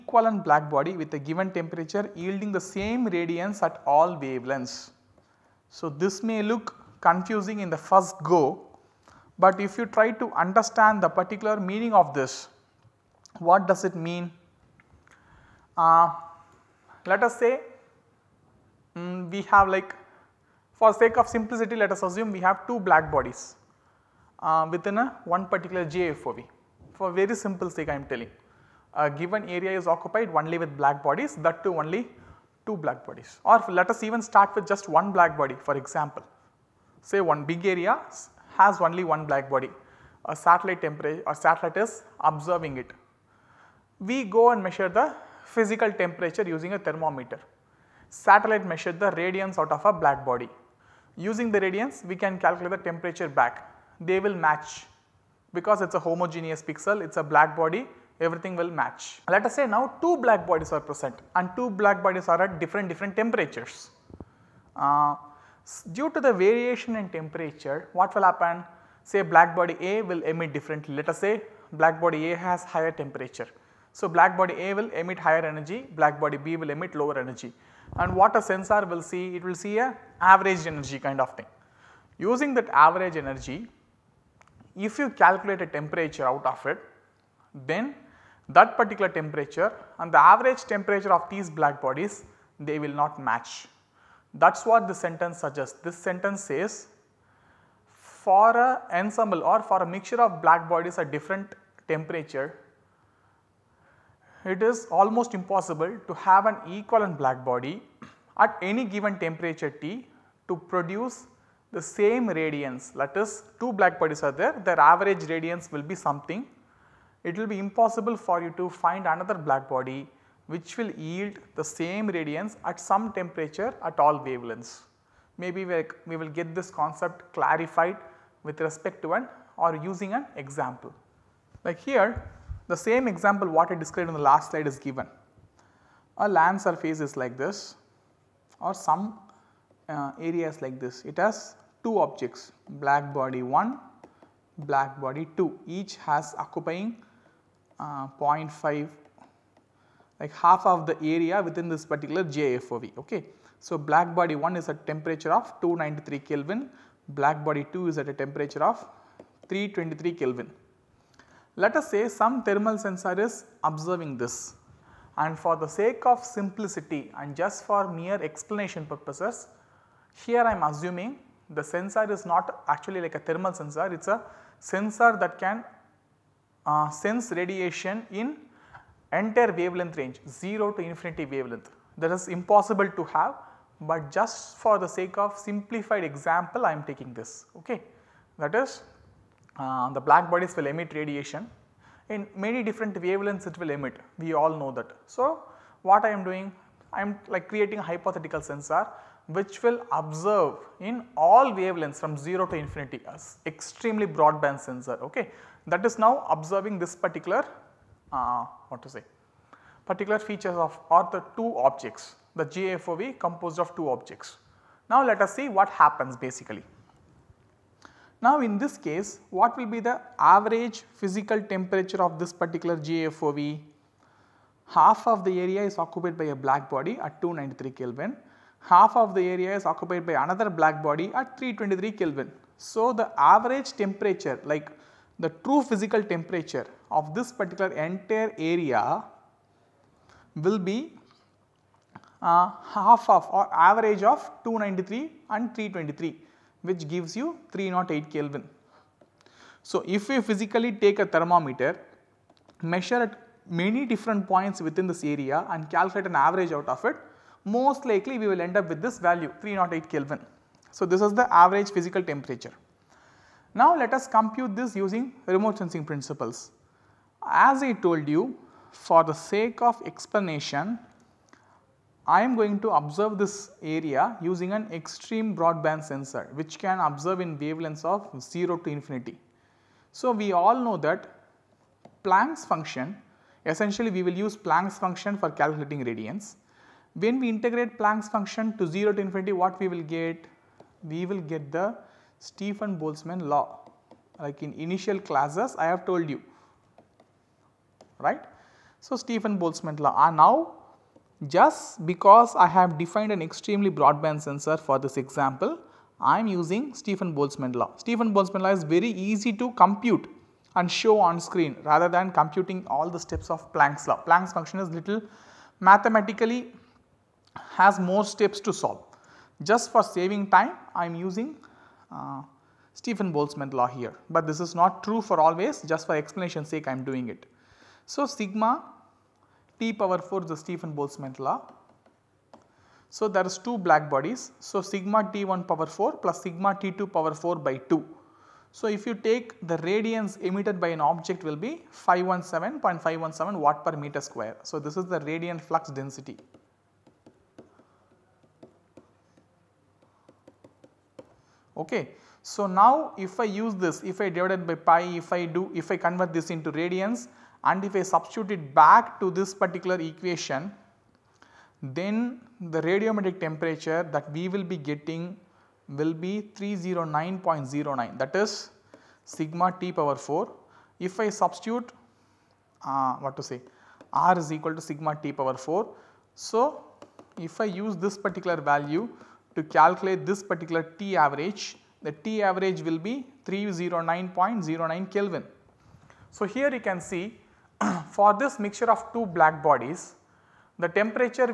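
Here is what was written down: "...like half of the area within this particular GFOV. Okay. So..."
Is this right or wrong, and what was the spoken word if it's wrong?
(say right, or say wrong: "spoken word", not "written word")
wrong: "GIFOV", not "GFOV".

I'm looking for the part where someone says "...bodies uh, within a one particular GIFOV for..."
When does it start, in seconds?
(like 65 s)
23 s.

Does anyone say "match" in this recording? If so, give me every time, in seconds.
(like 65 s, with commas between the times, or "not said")
54 s, 58 s, 93 s.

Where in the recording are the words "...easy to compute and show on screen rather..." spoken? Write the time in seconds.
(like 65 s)
308 s.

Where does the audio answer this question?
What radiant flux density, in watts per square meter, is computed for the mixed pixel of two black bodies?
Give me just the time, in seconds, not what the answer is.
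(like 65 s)
341 s.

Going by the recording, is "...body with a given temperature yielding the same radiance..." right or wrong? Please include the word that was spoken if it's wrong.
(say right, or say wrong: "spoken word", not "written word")
right.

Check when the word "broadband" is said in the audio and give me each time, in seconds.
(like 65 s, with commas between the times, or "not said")
204 s, 275 s, 303 s.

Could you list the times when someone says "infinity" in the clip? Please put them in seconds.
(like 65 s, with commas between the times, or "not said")
180 s, 202 s, 278 s, 289 s.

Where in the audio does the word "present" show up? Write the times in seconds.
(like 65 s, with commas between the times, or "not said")
60 s.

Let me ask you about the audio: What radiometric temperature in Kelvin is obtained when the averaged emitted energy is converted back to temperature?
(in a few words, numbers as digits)
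309.09 Kelvin.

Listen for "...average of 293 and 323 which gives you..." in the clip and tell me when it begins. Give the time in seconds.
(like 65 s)
243 s.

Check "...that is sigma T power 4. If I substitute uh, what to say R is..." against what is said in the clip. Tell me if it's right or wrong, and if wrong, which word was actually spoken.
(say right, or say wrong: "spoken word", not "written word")
right.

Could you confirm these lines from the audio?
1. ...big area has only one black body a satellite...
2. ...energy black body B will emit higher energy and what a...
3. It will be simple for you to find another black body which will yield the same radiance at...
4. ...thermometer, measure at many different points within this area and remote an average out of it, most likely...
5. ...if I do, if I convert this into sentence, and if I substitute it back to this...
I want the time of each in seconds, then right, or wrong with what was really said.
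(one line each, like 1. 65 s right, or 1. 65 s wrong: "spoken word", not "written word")
1. 37 s right
2. 75 s wrong: "lower", not "higher"
3. 117 s wrong: "impossible", not "simple"
4. 251 s wrong: "calculate", not "remote"
5. 355 s wrong: "radiance", not "sentence".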